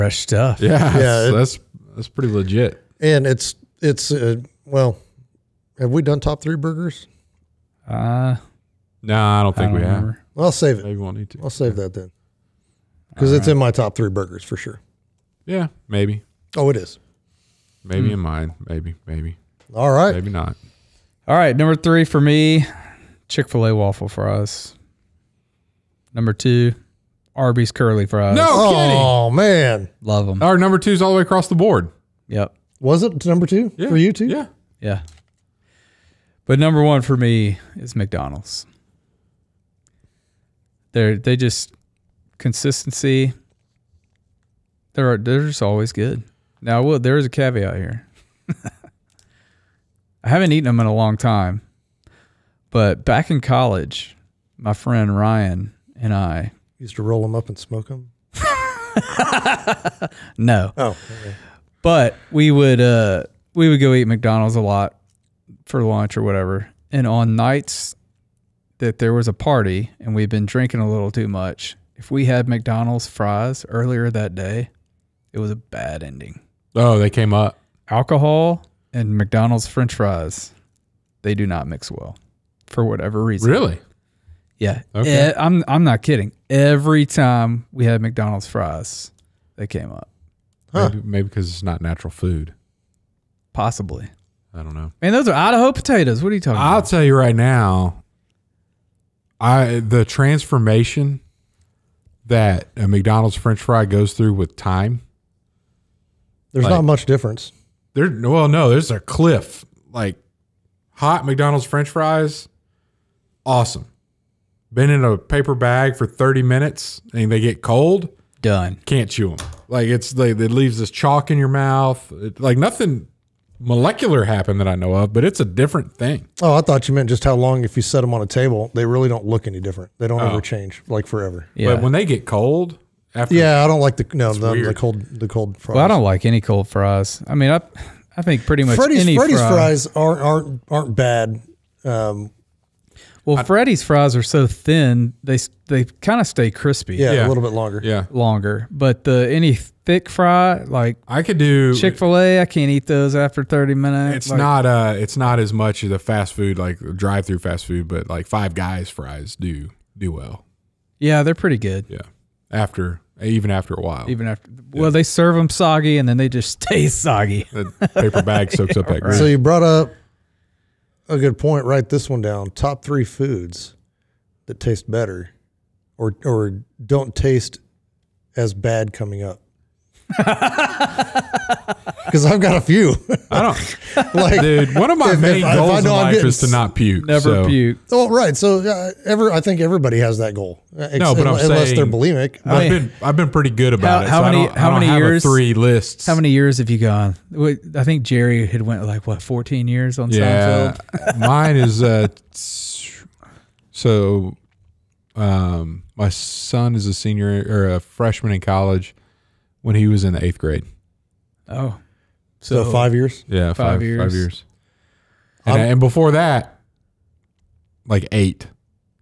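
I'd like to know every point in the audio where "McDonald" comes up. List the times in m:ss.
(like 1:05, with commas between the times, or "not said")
0:37, 1:04, 1:12, 1:19, 1:28, 1:42, 1:51.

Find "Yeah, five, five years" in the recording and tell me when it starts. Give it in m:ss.
3:33.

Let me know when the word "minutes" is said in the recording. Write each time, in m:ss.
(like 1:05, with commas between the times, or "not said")
1:56, 2:33.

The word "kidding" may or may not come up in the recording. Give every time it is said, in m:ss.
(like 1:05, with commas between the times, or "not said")
0:28, 1:26.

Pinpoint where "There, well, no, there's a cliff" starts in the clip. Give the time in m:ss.
1:47.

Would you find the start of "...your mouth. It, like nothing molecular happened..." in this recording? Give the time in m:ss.
2:01.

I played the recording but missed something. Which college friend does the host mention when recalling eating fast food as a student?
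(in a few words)
Ryan.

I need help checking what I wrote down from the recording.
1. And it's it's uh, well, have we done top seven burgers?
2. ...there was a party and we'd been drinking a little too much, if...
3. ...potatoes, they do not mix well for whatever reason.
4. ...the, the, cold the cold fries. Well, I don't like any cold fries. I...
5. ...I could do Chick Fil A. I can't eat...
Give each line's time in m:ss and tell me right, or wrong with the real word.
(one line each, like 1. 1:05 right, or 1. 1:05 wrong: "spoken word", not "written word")
1. 0:03 wrong: "three", not "seven"
2. 1:08 right
3. 1:19 wrong: "fries", not "potatoes"
4. 2:14 right
5. 2:31 right.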